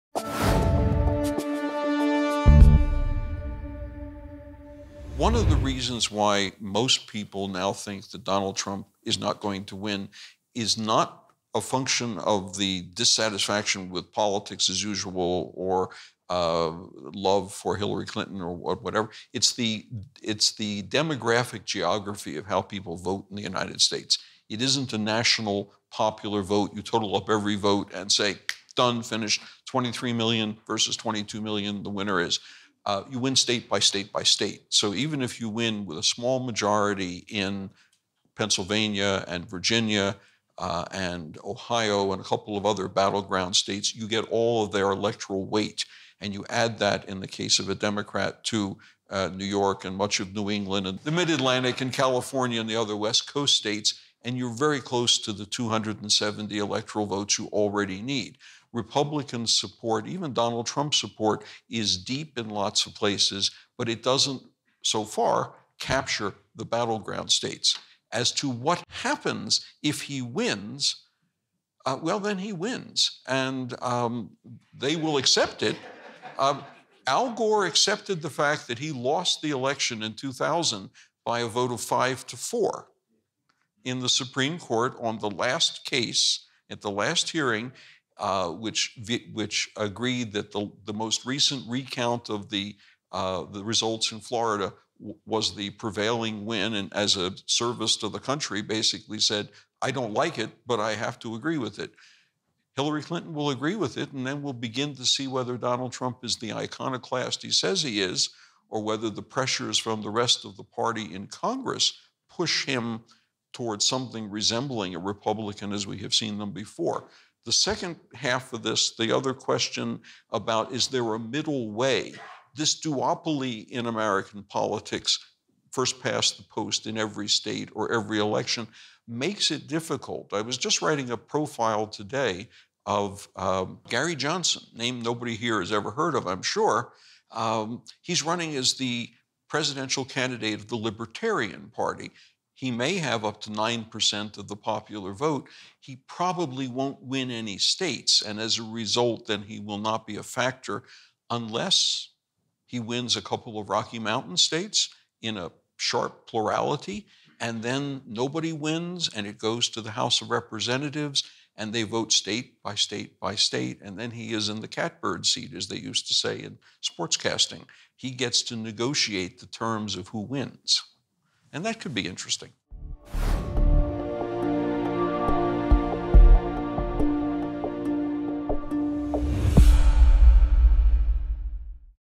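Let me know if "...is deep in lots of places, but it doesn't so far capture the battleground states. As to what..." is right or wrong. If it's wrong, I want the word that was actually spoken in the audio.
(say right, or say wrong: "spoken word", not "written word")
right.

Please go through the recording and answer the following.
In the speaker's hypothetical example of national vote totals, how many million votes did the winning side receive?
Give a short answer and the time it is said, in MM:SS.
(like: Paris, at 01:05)
23 million, at 00:29.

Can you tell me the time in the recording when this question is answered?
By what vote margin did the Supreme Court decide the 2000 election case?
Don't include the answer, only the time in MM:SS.
01:21.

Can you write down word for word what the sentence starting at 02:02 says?
This duopoly in American politics, first past the post in every state or every election, makes it difficult.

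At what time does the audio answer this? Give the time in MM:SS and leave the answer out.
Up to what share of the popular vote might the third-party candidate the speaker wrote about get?
02:23.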